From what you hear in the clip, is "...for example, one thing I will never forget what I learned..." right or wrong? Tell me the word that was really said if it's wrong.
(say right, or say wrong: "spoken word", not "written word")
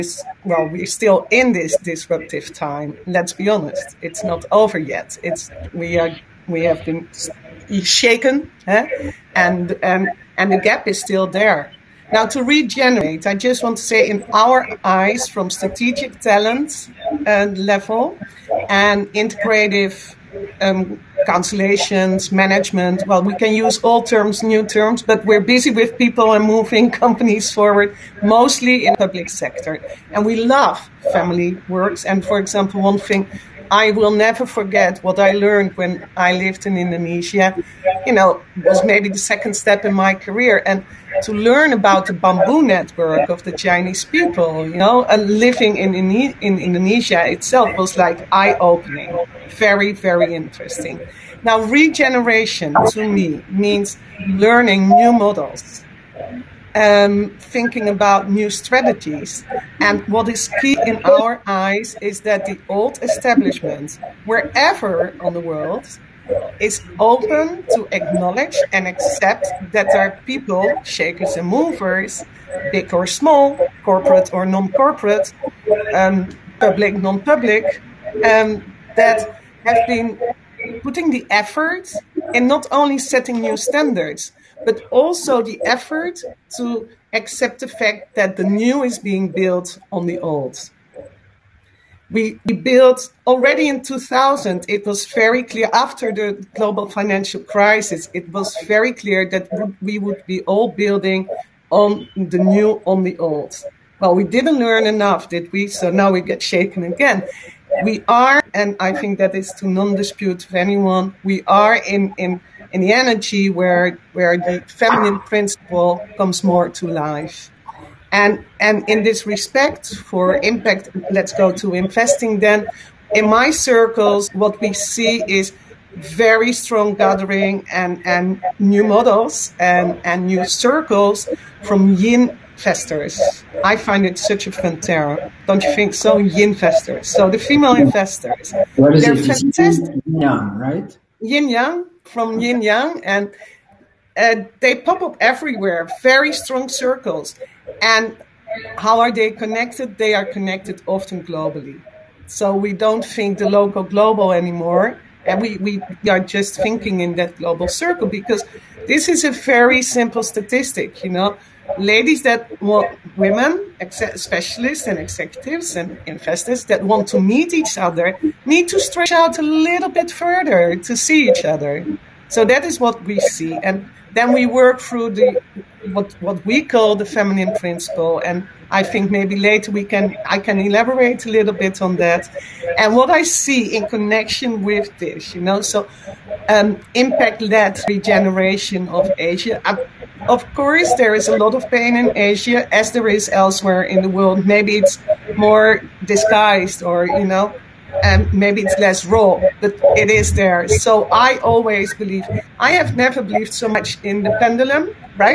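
right.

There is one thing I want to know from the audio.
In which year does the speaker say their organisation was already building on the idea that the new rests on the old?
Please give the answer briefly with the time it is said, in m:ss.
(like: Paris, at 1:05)
2000, at 1:33.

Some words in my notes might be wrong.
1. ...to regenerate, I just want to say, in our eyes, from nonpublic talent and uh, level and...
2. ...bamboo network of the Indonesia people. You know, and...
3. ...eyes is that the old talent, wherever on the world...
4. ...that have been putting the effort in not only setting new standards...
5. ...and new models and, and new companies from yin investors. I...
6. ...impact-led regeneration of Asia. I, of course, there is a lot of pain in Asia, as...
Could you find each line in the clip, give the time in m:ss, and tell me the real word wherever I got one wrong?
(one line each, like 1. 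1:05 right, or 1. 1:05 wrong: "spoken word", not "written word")
1. 0:12 wrong: "strategic", not "nonpublic"
2. 0:42 wrong: "Chinese", not "Indonesia"
3. 1:01 wrong: "establishment", not "talent"
4. 1:18 right
5. 2:08 wrong: "circles", not "companies"
6. 3:06 right.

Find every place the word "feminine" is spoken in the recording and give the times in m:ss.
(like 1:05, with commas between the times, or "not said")
1:54, 2:57.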